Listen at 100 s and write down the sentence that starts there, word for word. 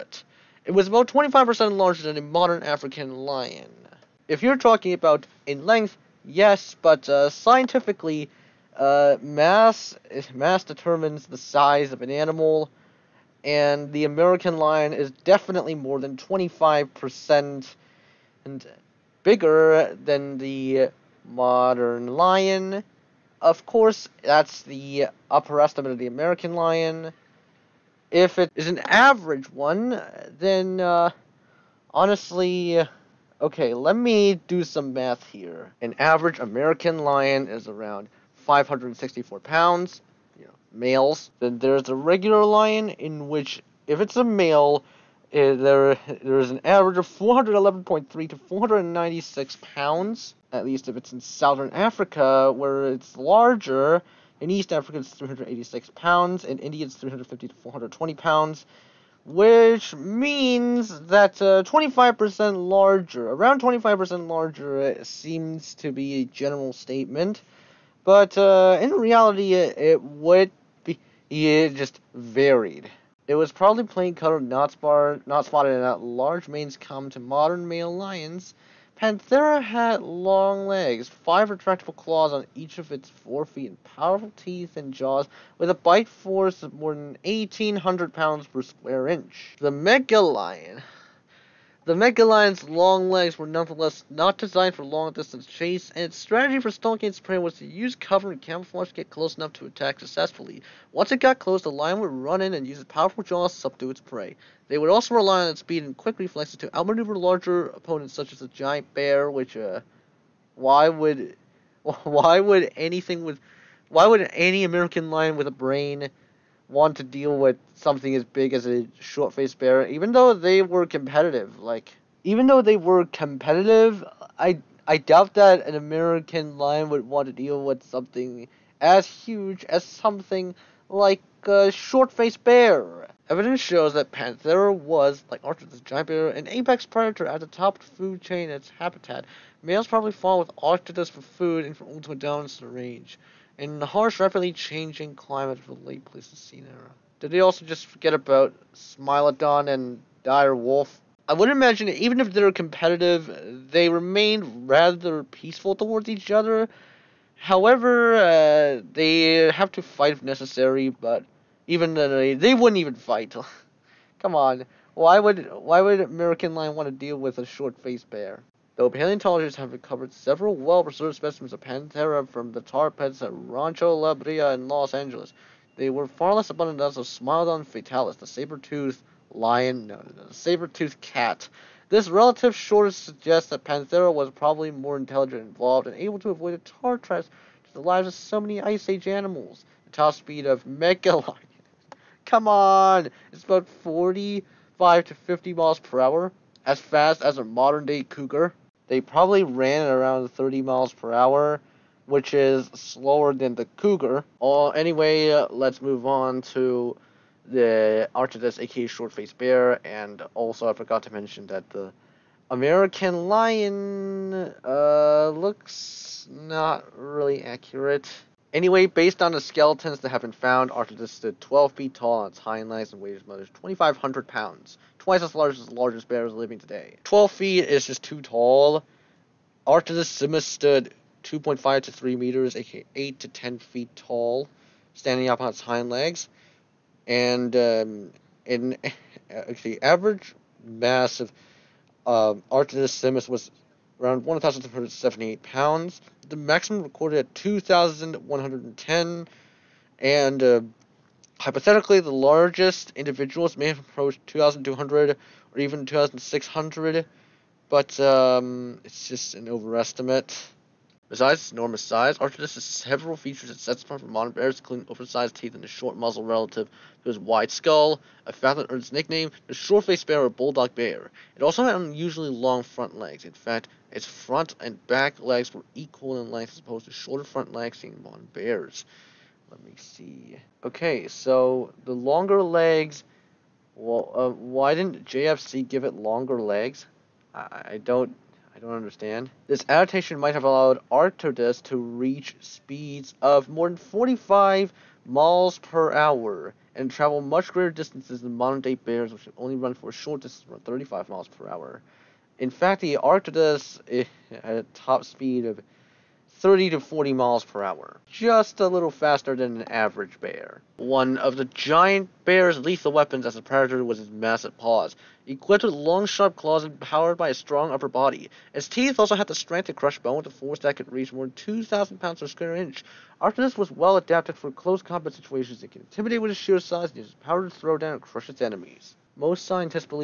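Once it got close, the lion would run in and use its powerful jaws to subdue its prey.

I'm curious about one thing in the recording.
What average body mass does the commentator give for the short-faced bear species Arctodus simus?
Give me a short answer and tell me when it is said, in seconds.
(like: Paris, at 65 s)
1,178 pounds, at 244 s.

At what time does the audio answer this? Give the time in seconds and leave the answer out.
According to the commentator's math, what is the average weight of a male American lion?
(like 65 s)
38 s.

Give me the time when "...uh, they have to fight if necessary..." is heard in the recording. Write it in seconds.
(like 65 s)
158 s.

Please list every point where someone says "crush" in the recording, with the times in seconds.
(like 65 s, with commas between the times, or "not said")
319 s, 328 s.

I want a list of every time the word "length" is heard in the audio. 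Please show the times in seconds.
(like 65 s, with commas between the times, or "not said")
5 s, 276 s.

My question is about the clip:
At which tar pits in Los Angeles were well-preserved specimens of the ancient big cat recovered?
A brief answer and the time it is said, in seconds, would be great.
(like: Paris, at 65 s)
Rancho La Brea, at 173 s.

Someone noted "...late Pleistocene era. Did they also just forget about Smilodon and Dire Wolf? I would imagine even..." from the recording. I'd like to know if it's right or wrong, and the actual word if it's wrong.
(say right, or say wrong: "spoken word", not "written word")
right.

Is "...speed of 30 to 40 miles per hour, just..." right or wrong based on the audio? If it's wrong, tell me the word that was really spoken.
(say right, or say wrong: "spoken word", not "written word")
right.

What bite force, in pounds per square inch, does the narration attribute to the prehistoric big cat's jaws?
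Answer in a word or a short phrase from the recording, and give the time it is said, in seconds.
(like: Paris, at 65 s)
more than 1,800, at 86 s.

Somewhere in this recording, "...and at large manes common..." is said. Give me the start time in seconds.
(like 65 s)
75 s.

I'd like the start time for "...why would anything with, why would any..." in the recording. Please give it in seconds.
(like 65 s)
112 s.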